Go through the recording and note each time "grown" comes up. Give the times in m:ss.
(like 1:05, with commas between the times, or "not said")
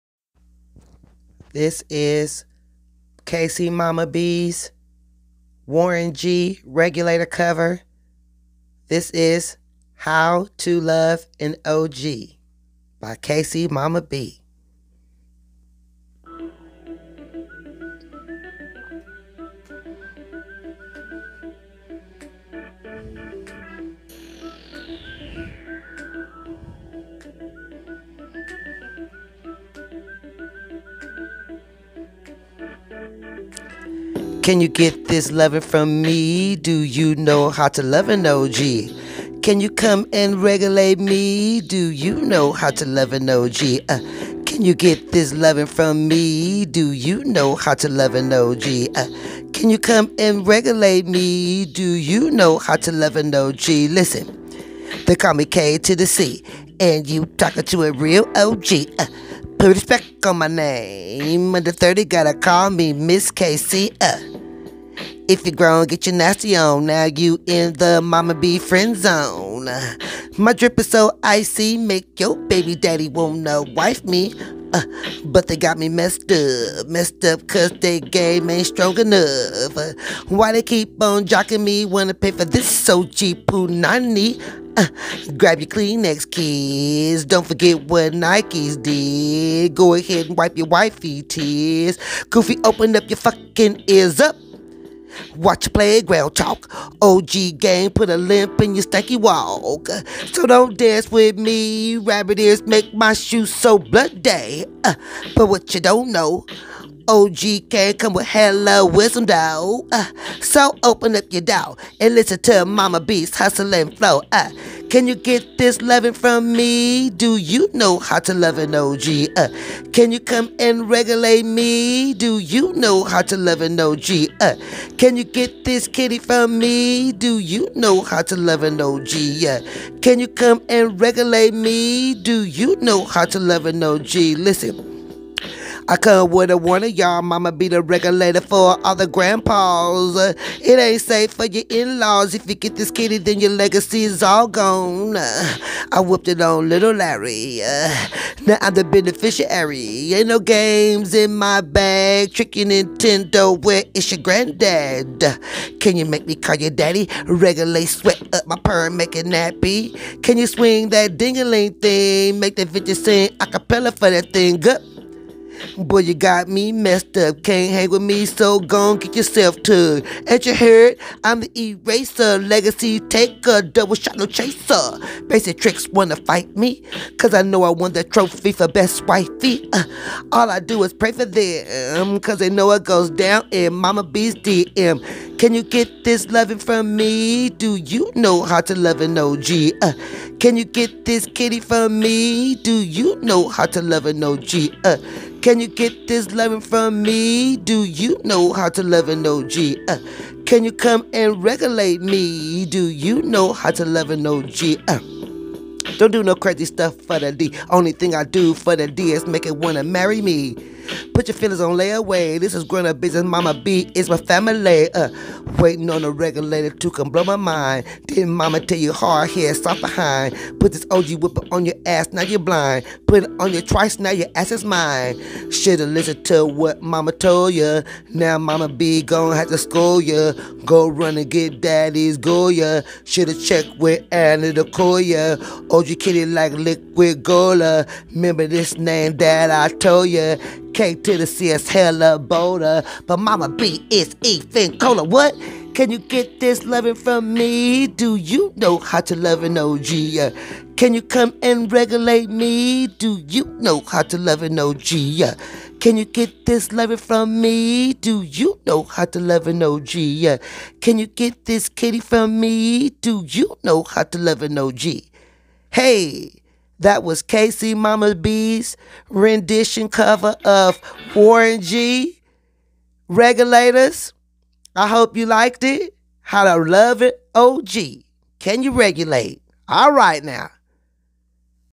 1:05, 3:32.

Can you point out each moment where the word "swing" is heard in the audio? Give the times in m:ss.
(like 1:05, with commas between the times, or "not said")
2:40.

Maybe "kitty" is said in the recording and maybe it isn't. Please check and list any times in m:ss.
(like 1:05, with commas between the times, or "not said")
2:05, 2:22, 3:11, 3:55, 4:21.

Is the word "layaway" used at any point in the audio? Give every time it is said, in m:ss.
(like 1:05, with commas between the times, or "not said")
3:31.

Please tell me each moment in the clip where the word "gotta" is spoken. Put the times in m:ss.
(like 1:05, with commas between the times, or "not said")
1:02.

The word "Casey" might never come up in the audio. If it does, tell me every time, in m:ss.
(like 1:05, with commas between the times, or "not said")
4:27.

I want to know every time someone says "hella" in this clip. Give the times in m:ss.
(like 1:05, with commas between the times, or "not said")
1:48, 4:01.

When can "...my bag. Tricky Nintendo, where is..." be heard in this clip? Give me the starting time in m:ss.
2:31.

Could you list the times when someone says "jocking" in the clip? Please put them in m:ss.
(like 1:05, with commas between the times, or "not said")
1:21.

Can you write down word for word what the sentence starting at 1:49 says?
Uh, so open up your door and listen to Mama Beast hustle and flow.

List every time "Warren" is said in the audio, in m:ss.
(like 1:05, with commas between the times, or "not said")
0:05, 4:31.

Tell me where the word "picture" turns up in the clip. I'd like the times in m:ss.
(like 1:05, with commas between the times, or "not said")
not said.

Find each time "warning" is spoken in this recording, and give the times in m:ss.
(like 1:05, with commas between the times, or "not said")
2:16.